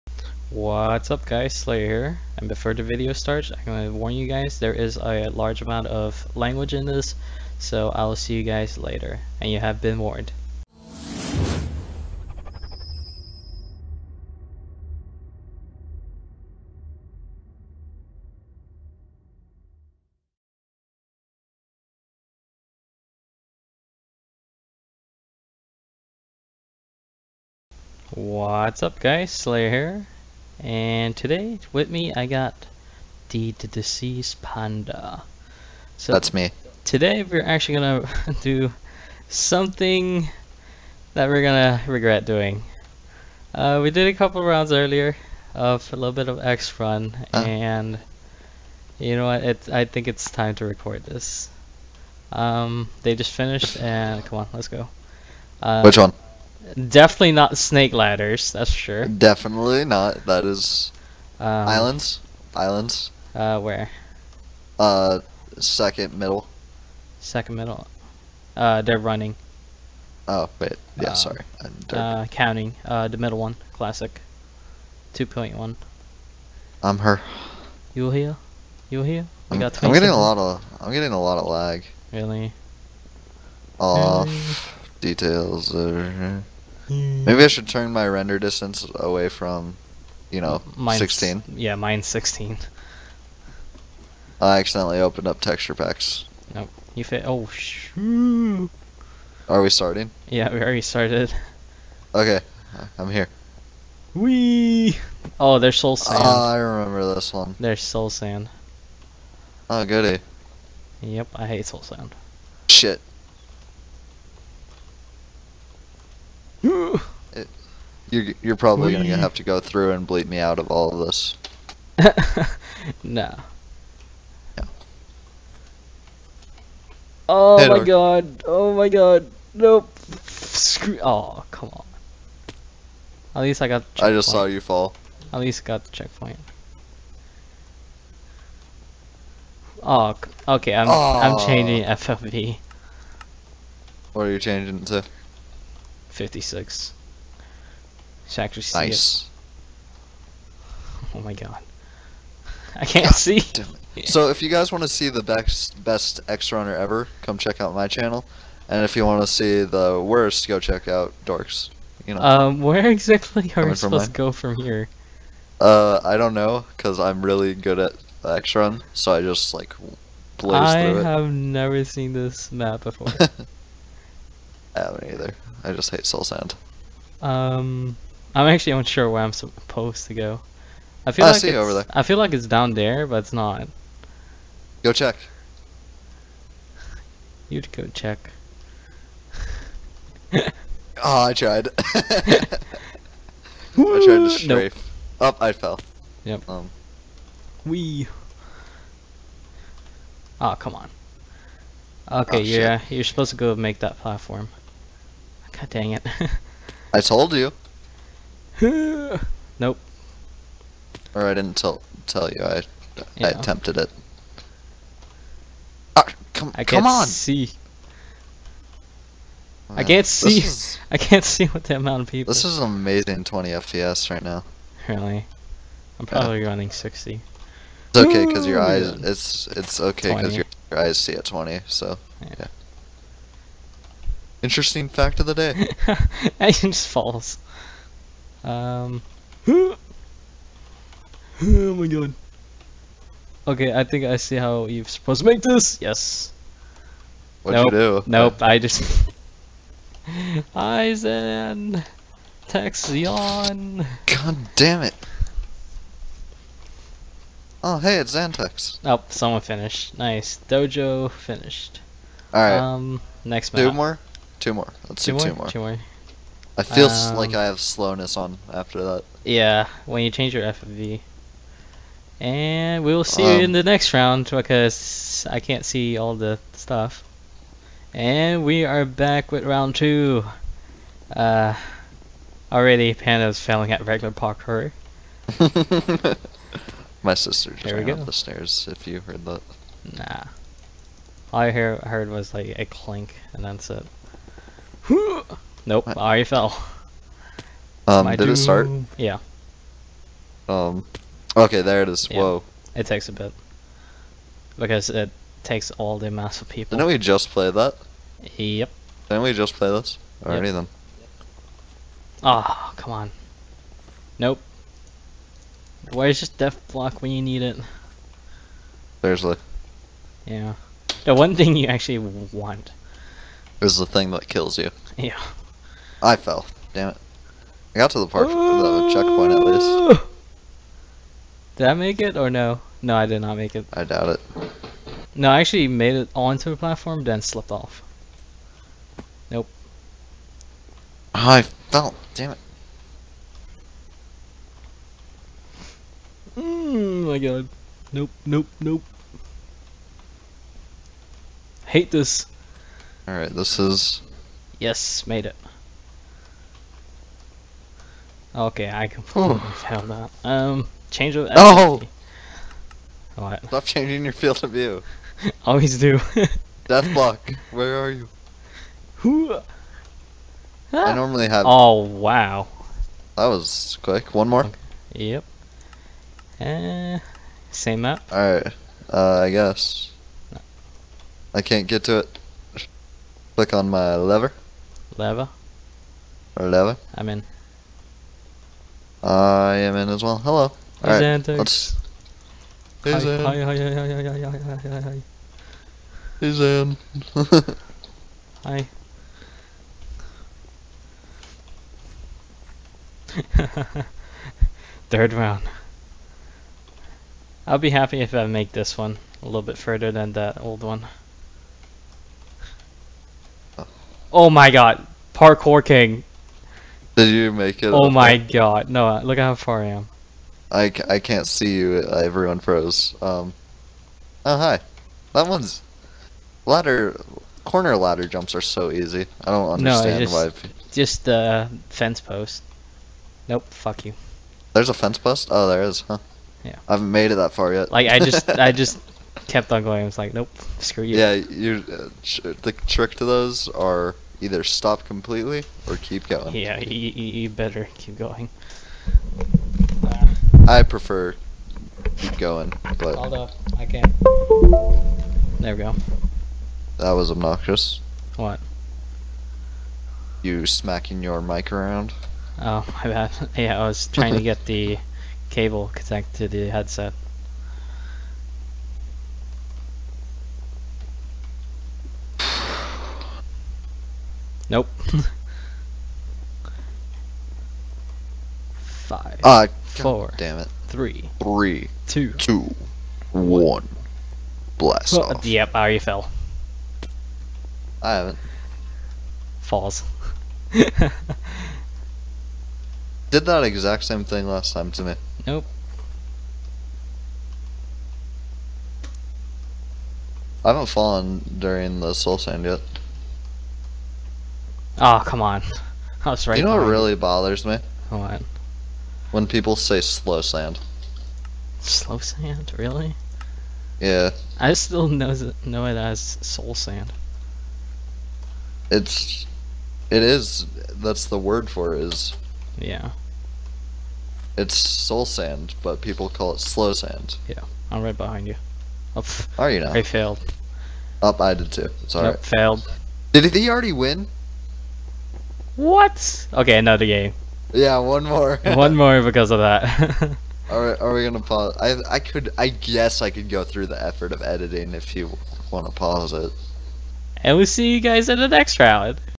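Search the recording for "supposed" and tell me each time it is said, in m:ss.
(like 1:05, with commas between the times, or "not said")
2:43, 2:59, 3:23, 4:04.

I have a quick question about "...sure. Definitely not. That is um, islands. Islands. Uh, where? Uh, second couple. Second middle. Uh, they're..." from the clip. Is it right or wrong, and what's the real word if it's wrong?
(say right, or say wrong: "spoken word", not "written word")
wrong: "middle", not "couple".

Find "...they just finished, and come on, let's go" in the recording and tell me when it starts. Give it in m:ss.
0:53.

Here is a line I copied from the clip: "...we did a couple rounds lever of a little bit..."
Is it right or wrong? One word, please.
wrong.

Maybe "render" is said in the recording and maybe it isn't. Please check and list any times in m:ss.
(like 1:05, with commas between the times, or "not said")
1:28.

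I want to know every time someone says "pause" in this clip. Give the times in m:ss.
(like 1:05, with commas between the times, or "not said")
9:01, 9:05.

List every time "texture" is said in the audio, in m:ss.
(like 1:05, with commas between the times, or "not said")
1:35.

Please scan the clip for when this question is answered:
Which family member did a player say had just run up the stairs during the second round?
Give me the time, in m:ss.
4:47.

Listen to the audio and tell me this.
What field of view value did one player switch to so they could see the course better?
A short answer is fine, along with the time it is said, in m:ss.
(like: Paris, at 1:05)
56, at 2:26.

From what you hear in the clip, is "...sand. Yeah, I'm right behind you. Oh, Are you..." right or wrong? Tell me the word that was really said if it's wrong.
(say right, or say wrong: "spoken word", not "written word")
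right.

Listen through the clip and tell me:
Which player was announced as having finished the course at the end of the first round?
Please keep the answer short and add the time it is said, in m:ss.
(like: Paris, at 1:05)
Dojo, at 4:20.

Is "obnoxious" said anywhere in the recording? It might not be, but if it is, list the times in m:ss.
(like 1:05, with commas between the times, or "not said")
7:37.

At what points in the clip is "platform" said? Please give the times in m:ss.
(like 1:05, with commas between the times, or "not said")
3:23, 5:36.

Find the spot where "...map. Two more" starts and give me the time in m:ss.
4:23.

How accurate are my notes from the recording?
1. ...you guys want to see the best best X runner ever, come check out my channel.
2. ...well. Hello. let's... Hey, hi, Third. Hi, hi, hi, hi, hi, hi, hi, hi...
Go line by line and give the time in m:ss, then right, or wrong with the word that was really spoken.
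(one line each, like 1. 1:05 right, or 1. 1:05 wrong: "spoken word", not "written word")
1. 2:34 right
2. 6:30 wrong: "Zan", not "Third".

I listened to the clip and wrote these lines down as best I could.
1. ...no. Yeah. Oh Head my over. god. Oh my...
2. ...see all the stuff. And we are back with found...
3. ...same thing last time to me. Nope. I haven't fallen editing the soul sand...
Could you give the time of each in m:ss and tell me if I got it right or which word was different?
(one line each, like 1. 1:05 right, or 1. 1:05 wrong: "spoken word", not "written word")
1. 2:03 right
2. 4:35 wrong: "round", not "found"
3. 8:13 wrong: "during", not "editing".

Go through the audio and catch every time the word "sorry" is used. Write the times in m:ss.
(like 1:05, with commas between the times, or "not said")
1:11.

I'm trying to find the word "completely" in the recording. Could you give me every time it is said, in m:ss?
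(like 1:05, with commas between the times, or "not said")
5:58, 7:24.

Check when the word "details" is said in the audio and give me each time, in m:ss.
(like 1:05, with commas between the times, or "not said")
1:25.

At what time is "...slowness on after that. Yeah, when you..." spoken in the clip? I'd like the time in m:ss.
4:27.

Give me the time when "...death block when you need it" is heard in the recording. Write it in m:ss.
5:16.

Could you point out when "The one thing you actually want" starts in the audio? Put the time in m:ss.
5:21.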